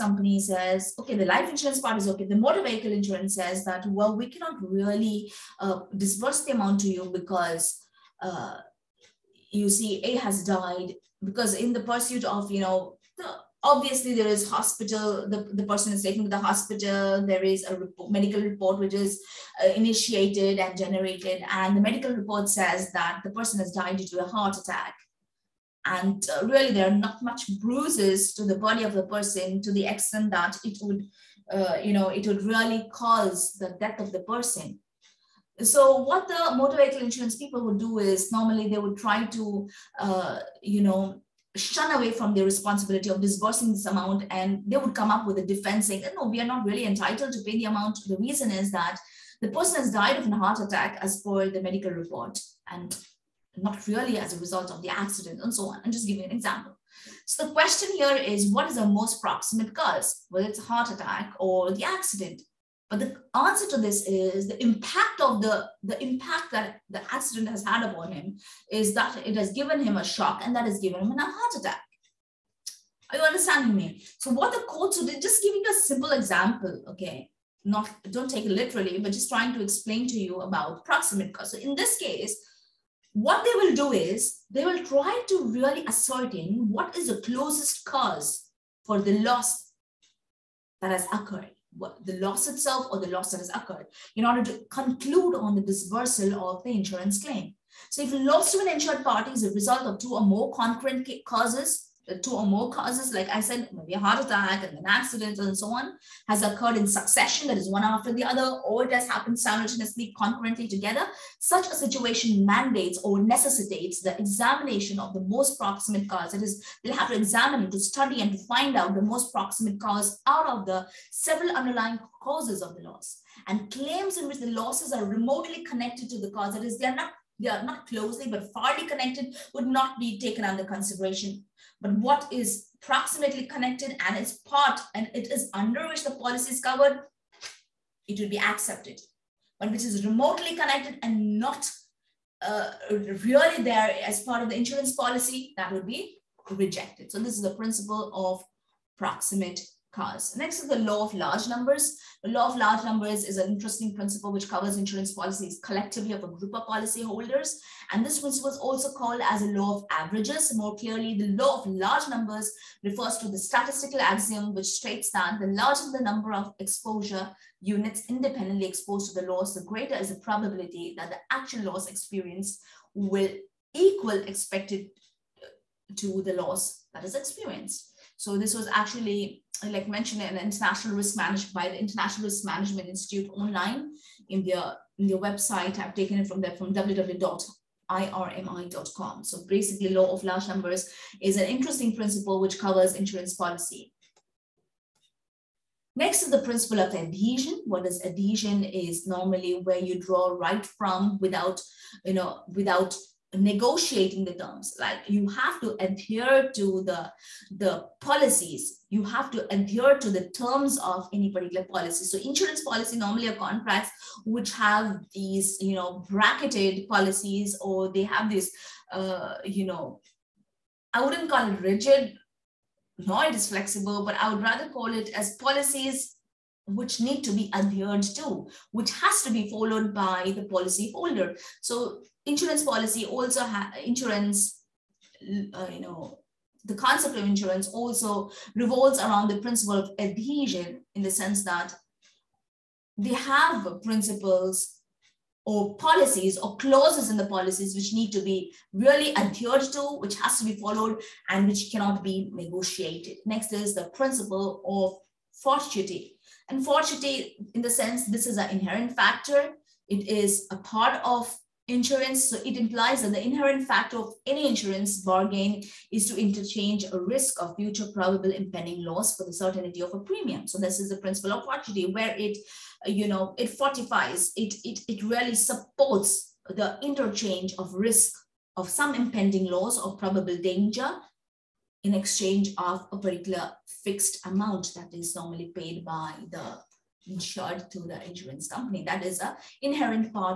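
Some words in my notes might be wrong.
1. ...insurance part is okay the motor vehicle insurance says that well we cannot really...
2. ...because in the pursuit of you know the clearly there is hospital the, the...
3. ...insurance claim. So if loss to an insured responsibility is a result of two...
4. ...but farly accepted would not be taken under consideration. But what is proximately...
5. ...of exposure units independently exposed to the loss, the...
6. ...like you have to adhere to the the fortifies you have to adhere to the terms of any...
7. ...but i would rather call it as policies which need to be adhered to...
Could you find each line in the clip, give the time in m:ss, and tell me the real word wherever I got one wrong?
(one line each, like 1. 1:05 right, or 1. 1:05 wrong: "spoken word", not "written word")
1. 0:01 right
2. 0:11 wrong: "obviously", not "clearly"
3. 1:36 wrong: "party", not "responsibility"
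4. 2:08 wrong: "connected", not "accepted"
5. 2:46 right
6. 3:24 wrong: "policies", not "fortifies"
7. 3:44 right.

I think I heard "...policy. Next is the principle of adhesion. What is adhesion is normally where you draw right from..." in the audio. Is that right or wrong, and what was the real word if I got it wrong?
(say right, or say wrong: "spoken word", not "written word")
right.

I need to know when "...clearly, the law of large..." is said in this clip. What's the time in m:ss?
2:40.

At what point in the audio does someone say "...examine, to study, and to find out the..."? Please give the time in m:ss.
1:57.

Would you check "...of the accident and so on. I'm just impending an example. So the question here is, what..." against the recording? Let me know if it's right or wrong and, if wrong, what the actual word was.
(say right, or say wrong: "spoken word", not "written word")
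wrong: "giving", not "impending".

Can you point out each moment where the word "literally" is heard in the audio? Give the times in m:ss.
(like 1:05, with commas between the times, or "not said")
1:18.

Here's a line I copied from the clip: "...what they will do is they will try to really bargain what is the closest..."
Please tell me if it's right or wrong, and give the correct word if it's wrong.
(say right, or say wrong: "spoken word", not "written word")
wrong: "ascertain", not "bargain".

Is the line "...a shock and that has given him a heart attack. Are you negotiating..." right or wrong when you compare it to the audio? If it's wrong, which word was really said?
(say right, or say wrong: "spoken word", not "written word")
wrong: "understanding", not "negotiating".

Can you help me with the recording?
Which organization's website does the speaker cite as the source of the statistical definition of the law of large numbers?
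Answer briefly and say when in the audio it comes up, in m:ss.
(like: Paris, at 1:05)
International Risk Management Institute, at 3:01.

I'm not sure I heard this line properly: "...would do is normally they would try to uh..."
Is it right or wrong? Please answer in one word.
right.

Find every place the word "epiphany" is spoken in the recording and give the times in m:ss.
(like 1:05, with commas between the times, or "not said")
not said.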